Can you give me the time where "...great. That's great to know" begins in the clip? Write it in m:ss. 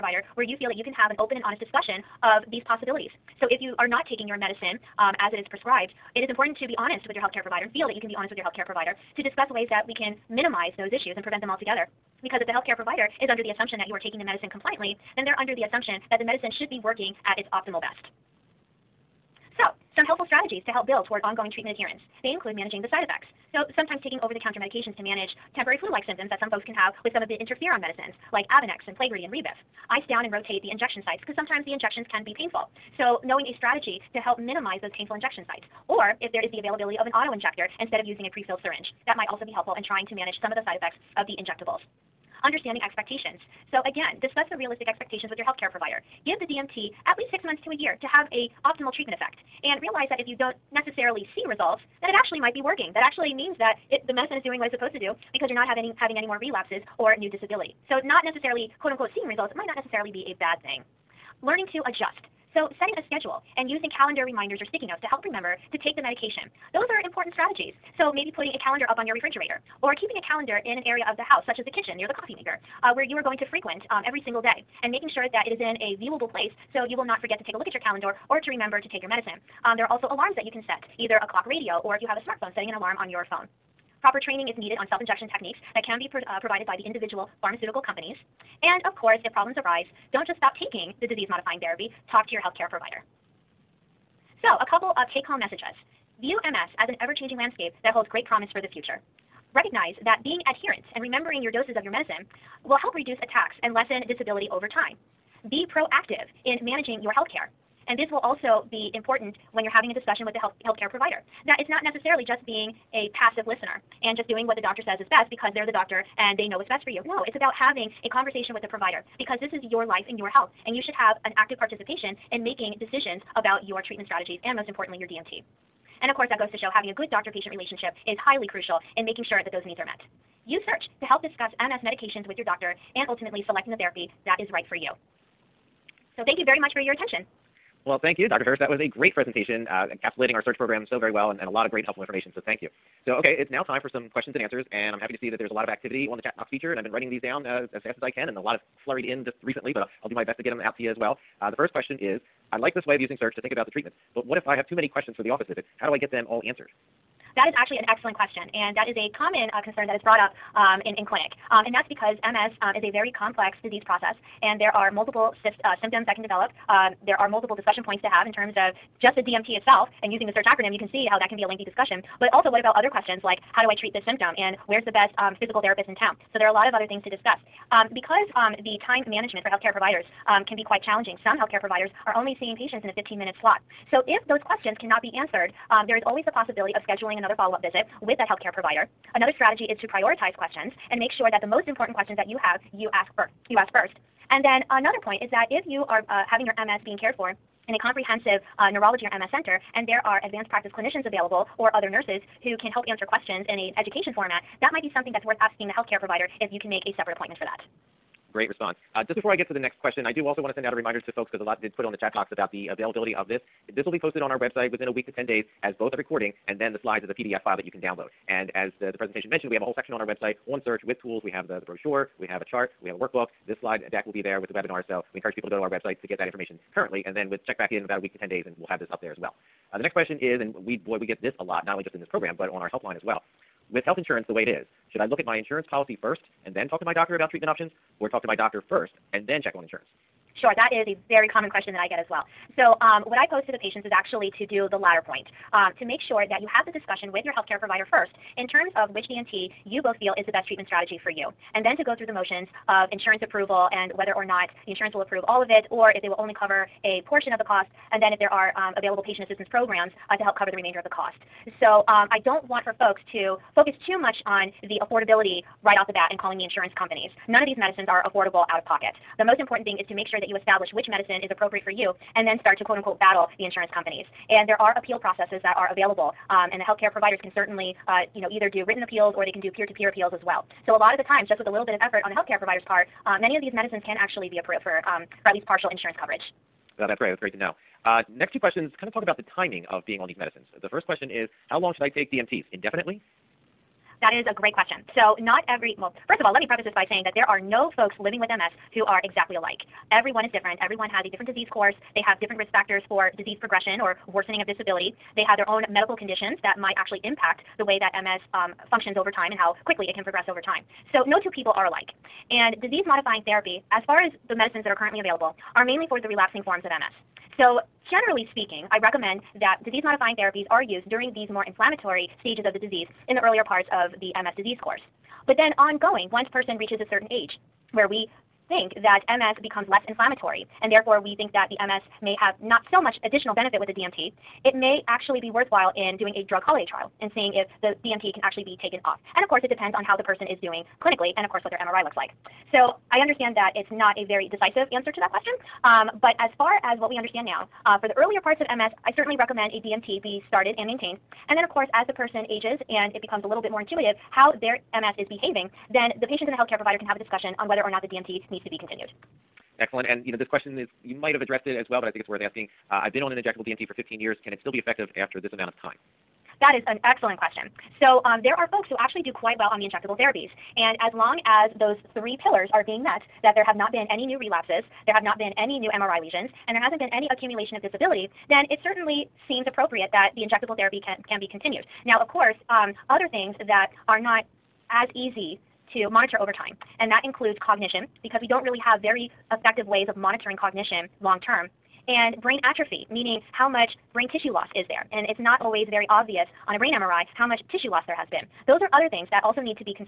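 4:46.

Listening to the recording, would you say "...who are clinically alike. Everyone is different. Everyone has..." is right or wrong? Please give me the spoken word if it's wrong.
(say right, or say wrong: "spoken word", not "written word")
wrong: "exactly", not "clinically".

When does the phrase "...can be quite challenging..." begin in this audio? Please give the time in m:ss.
3:00.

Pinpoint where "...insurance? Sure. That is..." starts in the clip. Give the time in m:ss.
3:59.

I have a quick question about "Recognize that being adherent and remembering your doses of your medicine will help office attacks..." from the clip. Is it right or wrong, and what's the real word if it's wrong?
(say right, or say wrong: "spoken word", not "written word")
wrong: "reduce", not "office".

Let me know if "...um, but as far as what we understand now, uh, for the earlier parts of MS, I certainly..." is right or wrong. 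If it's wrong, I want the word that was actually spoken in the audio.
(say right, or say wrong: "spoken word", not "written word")
right.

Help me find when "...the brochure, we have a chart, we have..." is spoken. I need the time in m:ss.
3:41.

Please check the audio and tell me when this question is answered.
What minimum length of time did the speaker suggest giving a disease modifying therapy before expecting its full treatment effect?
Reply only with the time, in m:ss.
0:47.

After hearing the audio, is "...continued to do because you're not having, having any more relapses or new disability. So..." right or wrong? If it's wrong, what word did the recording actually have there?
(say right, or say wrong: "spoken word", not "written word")
wrong: "supposed", not "continued".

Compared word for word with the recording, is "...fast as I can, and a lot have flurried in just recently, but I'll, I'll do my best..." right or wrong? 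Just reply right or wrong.
right.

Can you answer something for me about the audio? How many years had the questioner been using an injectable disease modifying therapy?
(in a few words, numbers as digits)
15.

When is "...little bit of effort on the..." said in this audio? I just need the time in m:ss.
4:41.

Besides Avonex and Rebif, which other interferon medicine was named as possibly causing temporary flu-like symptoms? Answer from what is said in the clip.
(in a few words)
Plegridy.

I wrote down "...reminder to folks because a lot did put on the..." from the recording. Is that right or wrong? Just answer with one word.
right.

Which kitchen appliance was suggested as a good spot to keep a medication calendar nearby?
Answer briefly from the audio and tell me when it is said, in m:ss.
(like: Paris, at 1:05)
coffee maker, at 1:12.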